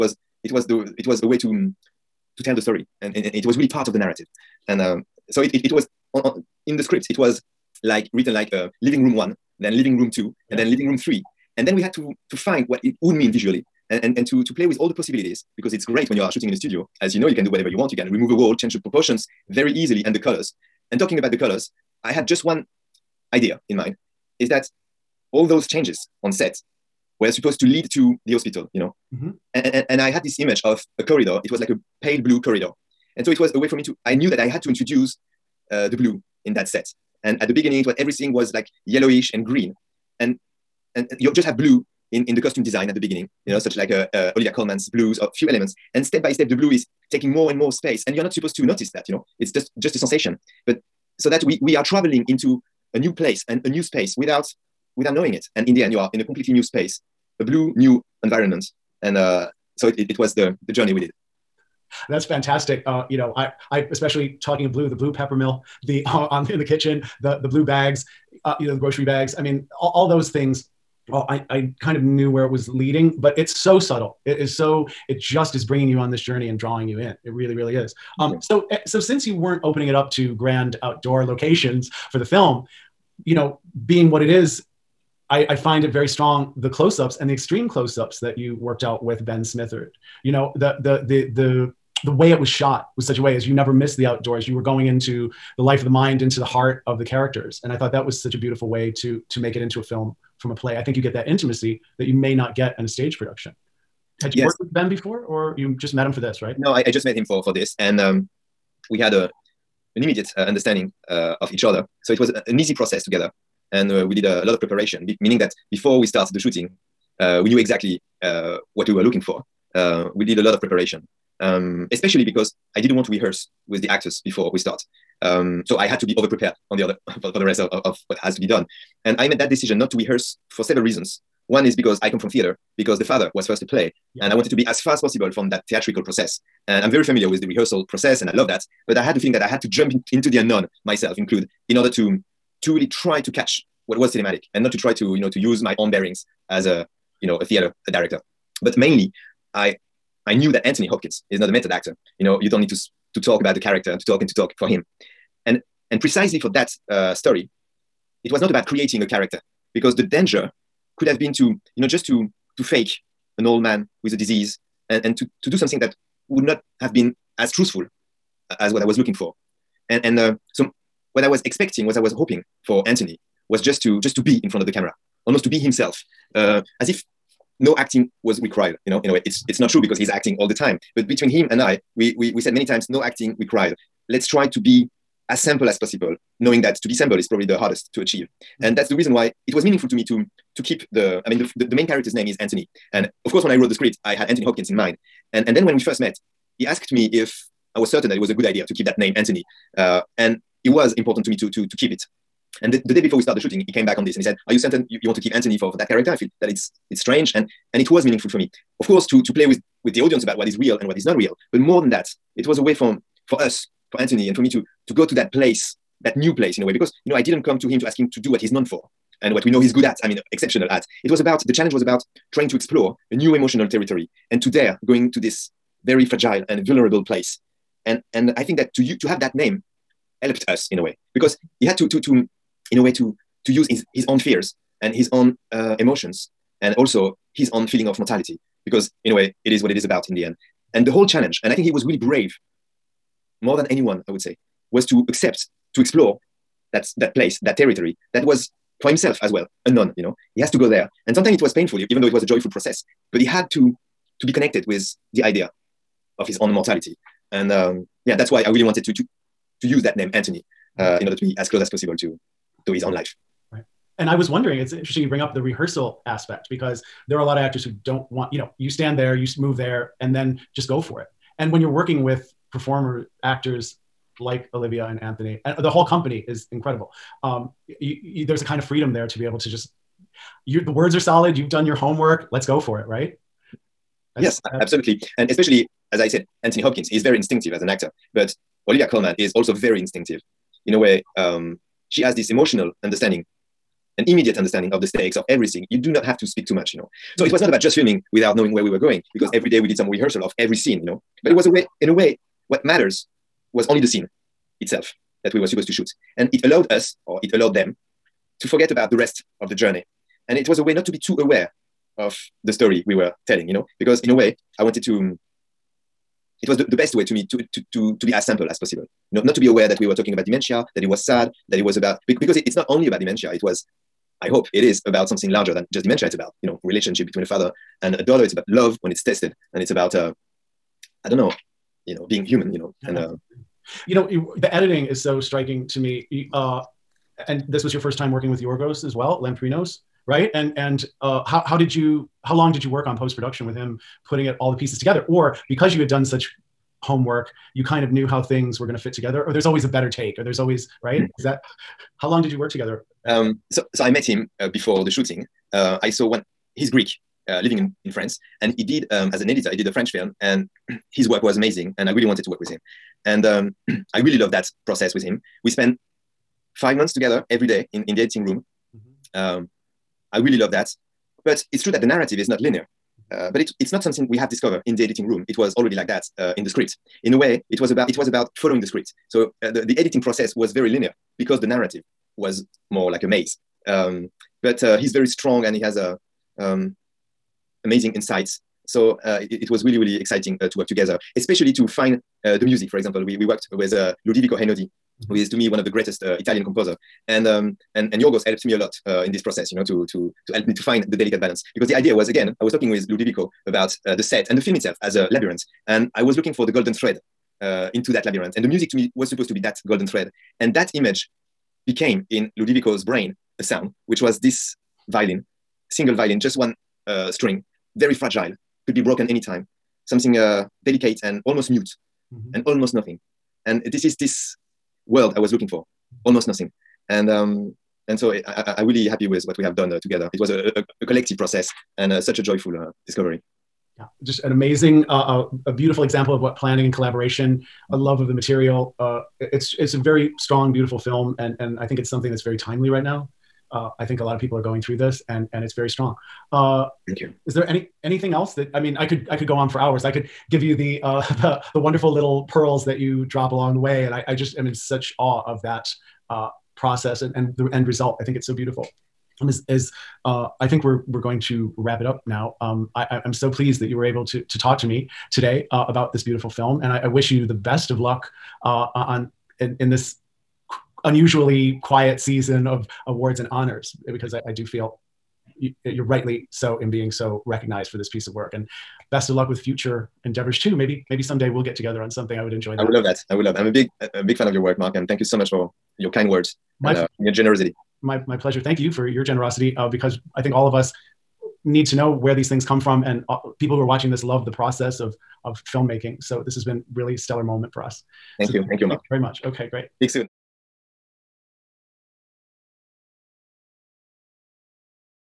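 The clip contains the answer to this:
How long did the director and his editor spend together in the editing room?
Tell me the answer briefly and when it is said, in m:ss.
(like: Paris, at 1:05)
5 months, at 6:06.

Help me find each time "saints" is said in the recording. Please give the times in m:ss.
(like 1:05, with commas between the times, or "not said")
not said.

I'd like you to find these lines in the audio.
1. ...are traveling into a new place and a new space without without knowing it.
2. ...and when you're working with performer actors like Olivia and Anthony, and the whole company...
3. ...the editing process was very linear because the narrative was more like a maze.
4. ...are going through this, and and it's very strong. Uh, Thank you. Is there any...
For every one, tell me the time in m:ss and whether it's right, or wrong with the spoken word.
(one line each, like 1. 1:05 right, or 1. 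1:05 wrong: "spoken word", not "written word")
1. 0:51 right
2. 4:31 right
3. 6:19 right
4. 7:24 right.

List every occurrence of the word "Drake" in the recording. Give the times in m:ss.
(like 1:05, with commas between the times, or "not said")
not said.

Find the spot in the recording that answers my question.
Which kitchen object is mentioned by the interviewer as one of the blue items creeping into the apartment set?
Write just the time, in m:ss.
1:05.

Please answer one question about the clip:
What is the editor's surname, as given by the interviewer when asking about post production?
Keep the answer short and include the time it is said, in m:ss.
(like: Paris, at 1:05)
Lamprinos, at 5:39.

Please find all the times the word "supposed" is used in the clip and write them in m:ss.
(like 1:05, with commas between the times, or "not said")
0:27, 0:48, 5:05, 6:49.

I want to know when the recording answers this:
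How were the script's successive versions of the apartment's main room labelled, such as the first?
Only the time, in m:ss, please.
0:08.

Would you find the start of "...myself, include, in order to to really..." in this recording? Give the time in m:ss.
2:20.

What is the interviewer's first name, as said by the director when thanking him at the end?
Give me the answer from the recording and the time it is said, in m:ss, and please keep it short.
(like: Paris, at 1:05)
Mark, at 8:04.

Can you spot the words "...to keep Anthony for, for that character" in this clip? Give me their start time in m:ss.
3:25.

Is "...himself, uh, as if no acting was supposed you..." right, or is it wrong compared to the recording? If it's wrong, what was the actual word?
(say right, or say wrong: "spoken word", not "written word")
wrong: "required", not "supposed".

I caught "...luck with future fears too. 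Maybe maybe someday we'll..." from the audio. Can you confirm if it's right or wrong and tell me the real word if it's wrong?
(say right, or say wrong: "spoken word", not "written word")
wrong: "endeavors", not "fears".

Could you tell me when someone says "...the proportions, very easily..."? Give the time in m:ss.
0:18.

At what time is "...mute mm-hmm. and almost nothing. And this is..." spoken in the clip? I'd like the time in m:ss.
7:01.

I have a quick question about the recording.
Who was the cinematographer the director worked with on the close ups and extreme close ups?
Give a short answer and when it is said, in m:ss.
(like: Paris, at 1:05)
Ben Smithard, at 1:29.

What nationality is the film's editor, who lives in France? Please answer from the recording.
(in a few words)
Greek.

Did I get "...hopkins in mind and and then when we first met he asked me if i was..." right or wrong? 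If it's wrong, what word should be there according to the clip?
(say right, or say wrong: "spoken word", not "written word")
right.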